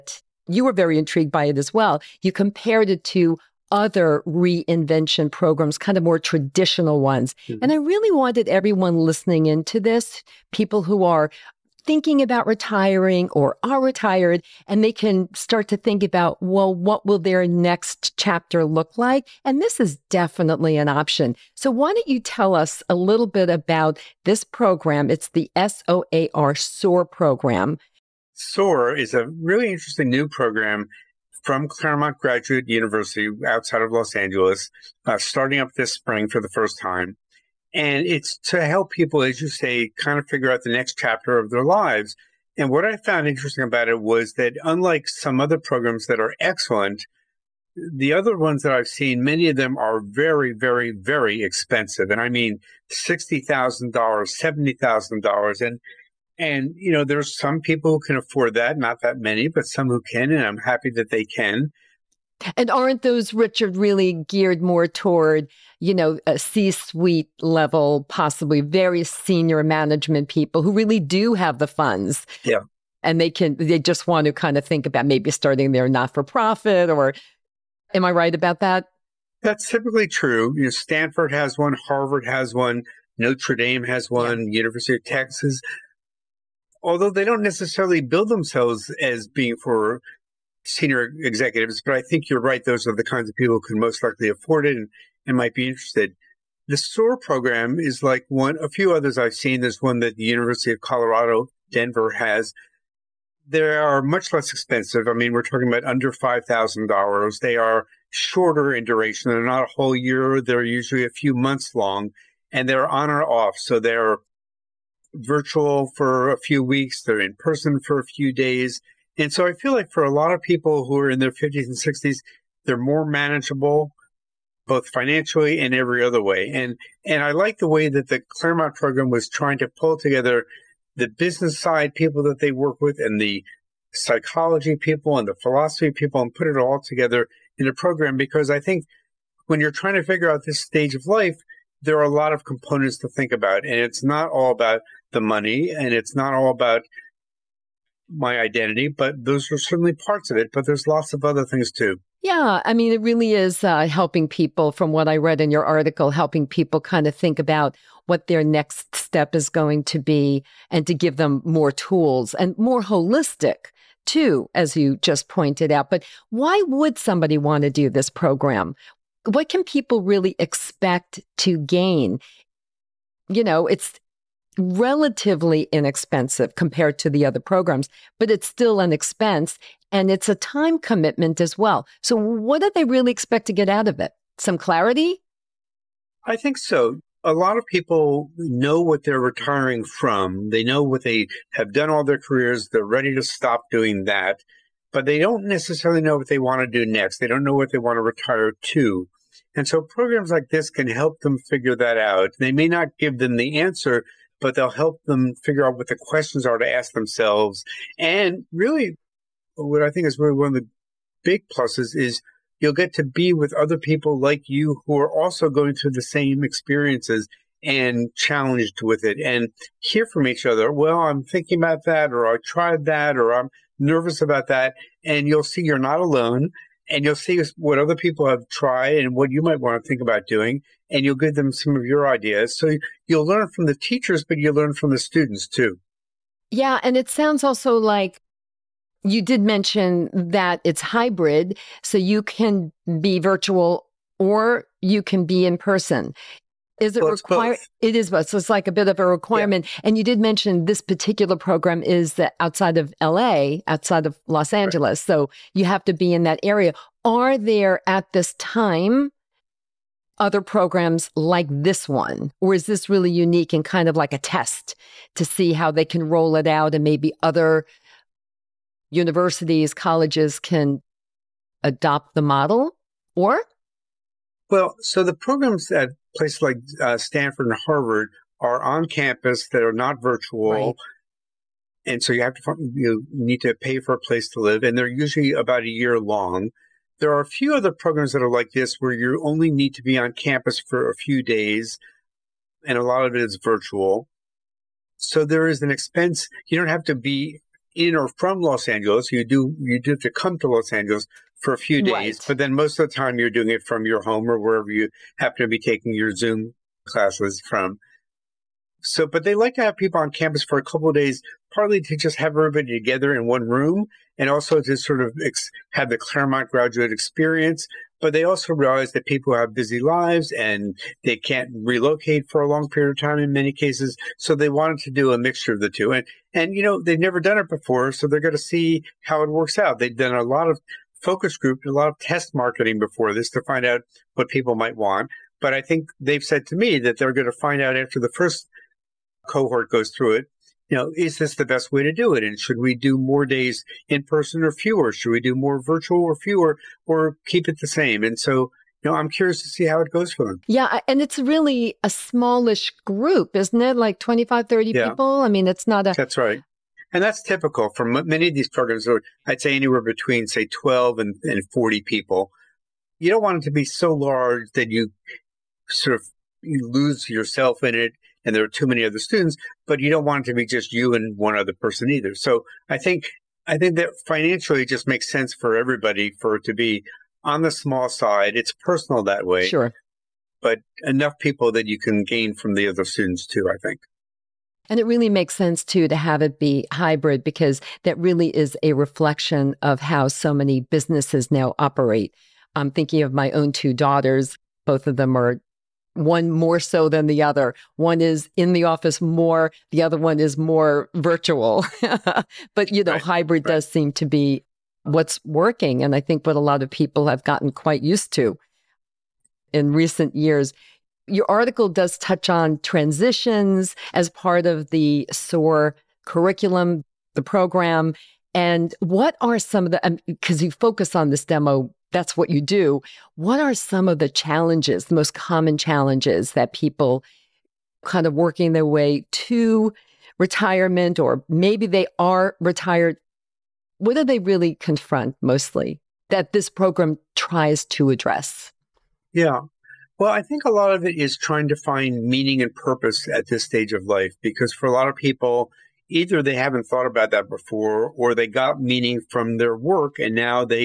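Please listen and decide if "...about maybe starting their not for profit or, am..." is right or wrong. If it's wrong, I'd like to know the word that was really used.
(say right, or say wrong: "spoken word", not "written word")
right.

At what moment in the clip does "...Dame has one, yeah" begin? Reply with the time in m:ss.
1:23.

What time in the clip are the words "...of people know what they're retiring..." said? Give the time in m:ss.
3:07.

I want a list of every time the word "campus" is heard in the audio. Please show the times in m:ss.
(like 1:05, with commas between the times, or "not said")
4:38, 4:50, 5:10.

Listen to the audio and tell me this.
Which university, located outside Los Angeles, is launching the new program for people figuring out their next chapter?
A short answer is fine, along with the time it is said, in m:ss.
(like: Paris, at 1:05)
Claremont Graduate University, at 0:31.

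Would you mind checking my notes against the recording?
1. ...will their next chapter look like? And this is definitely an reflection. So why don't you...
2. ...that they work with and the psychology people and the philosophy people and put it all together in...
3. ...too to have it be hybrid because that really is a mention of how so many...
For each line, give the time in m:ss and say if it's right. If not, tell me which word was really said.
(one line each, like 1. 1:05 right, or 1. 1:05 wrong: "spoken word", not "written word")
1. 0:17 wrong: "option", not "reflection"
2. 2:12 right
3. 6:25 wrong: "reflection", not "mention".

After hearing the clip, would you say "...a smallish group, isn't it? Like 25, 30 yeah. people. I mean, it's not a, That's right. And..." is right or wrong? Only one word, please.
right.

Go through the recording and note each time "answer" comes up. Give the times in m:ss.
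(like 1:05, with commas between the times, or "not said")
3:23.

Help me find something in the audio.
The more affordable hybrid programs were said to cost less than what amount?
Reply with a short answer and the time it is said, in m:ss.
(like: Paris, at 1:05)
$5,000, at 1:46.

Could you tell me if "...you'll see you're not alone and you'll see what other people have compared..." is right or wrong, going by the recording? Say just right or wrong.
wrong.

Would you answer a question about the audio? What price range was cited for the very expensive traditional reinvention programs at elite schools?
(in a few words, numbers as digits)
$60,000, $70,000.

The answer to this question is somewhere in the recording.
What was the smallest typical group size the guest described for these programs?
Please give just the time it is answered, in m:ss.
6:00.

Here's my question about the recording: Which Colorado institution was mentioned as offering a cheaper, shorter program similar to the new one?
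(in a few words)
University of Colorado Denver.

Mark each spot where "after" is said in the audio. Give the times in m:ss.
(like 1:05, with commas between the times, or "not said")
5:37.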